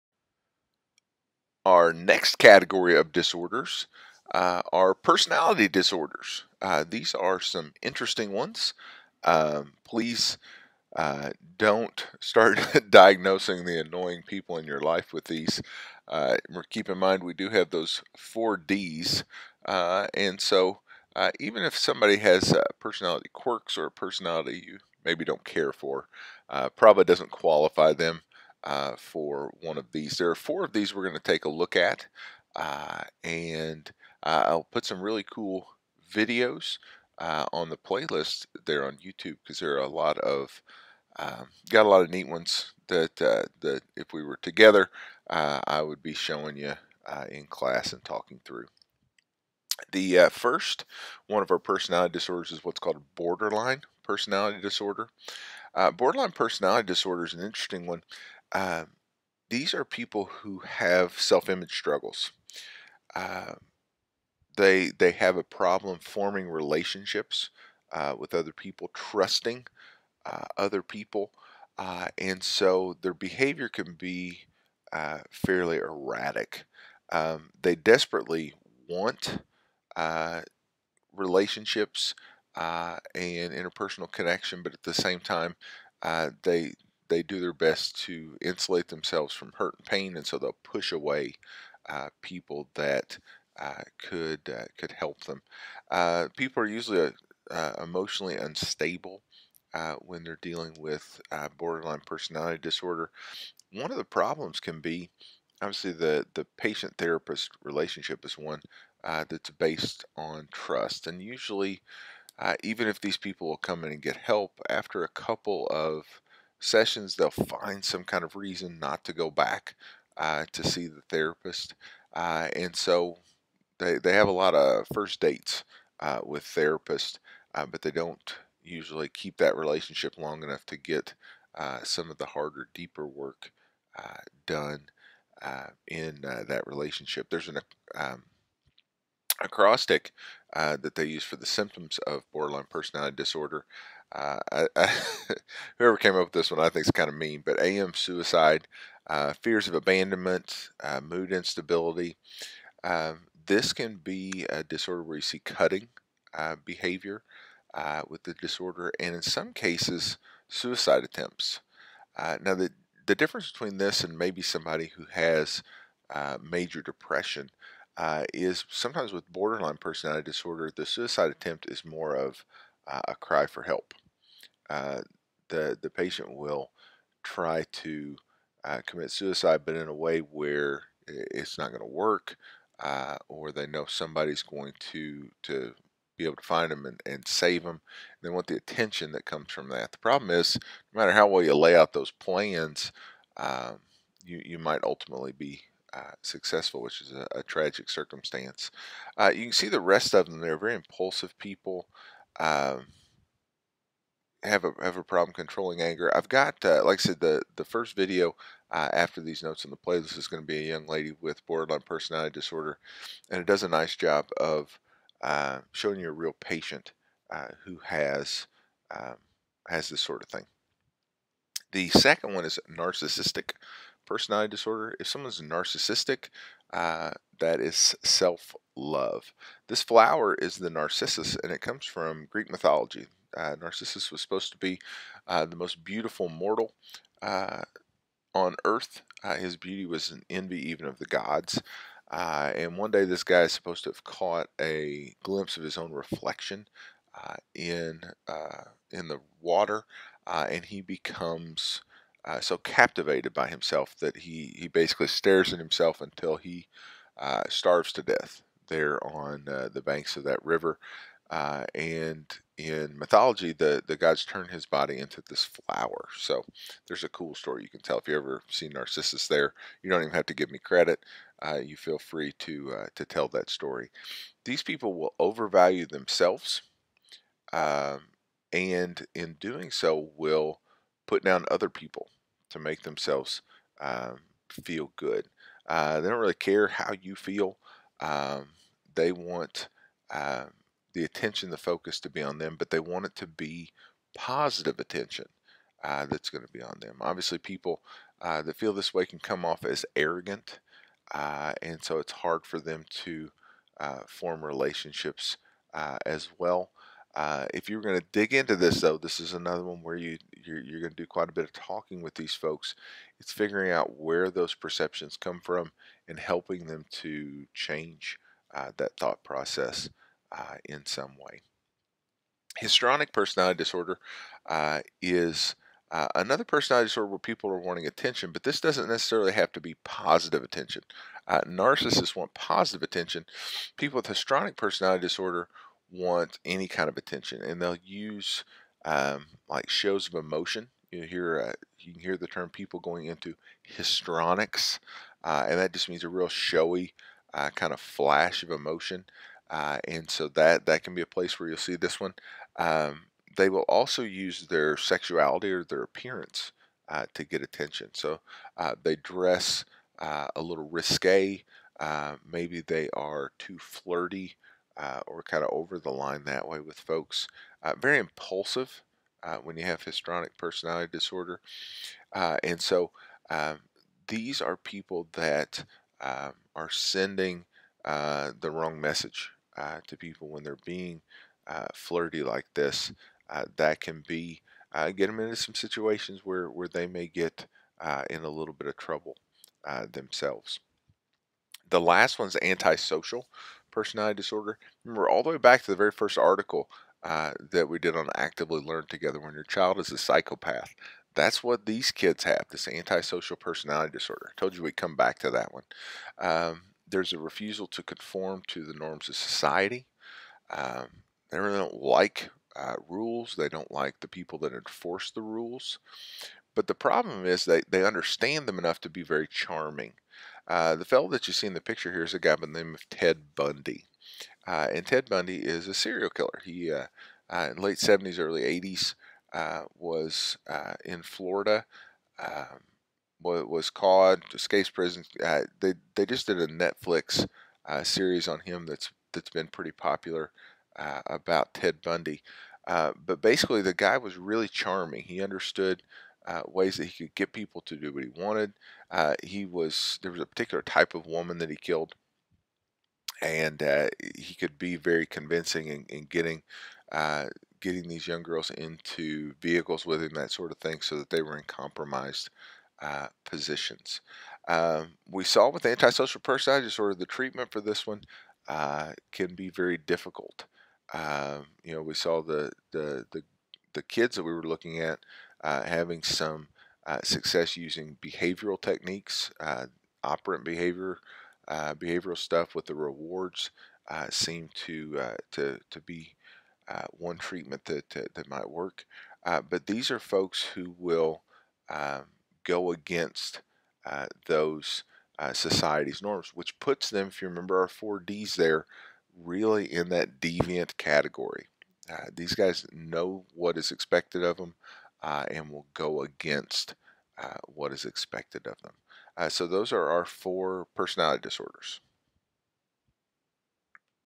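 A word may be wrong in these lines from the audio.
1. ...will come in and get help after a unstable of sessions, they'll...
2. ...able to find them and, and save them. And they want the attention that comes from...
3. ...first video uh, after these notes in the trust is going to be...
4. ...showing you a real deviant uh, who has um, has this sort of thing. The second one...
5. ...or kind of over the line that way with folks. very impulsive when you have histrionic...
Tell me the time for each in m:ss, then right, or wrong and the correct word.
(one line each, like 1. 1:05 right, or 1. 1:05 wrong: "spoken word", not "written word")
1. 1:53 wrong: "couple", not "unstable"
2. 3:06 right
3. 3:27 wrong: "playlist", not "trust"
4. 3:35 wrong: "patient", not "deviant"
5. 6:05 right.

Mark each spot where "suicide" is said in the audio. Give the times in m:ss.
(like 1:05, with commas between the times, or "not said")
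2:27, 2:40, 2:50, 2:59.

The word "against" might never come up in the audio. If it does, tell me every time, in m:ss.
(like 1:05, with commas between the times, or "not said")
8:12, 8:26.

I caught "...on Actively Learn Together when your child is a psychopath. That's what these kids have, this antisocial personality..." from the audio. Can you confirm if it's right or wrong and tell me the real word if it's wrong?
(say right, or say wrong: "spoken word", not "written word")
right.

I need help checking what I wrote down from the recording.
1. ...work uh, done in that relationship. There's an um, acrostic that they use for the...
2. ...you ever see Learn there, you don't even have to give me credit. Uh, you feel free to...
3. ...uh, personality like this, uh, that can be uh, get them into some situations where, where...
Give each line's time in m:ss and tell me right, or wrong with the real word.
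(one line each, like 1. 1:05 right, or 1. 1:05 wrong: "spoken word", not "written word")
1. 2:13 right
2. 4:28 wrong: "Narcissus", not "Learn"
3. 6:21 wrong: "flirty", not "personality".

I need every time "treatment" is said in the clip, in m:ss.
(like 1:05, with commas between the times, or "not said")
7:47, 8:07.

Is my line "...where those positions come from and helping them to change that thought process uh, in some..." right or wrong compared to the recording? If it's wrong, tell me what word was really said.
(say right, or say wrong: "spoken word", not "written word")
wrong: "perceptions", not "positions".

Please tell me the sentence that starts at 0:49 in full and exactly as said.
The uh, first one of our personality disorders is what's called borderline personality disorder.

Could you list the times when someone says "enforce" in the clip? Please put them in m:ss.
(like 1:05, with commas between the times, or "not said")
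6:54.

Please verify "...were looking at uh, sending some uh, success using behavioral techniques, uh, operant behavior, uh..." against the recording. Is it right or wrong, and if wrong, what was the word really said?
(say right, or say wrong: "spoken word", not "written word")
wrong: "having", not "sending".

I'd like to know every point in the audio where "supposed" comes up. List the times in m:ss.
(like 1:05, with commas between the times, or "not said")
3:54, 4:03.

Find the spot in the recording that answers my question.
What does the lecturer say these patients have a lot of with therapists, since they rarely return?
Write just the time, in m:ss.
2:04.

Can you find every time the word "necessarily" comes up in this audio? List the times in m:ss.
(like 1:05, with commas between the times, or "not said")
5:28.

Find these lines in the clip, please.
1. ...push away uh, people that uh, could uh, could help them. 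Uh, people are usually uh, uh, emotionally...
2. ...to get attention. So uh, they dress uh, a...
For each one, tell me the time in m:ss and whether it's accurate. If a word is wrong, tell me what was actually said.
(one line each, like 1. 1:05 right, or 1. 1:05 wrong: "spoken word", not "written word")
1. 1:30 right
2. 5:57 right.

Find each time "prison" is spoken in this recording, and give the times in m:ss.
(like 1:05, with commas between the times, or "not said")
7:14.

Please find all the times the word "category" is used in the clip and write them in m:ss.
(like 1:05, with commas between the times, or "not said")
0:02, 8:20.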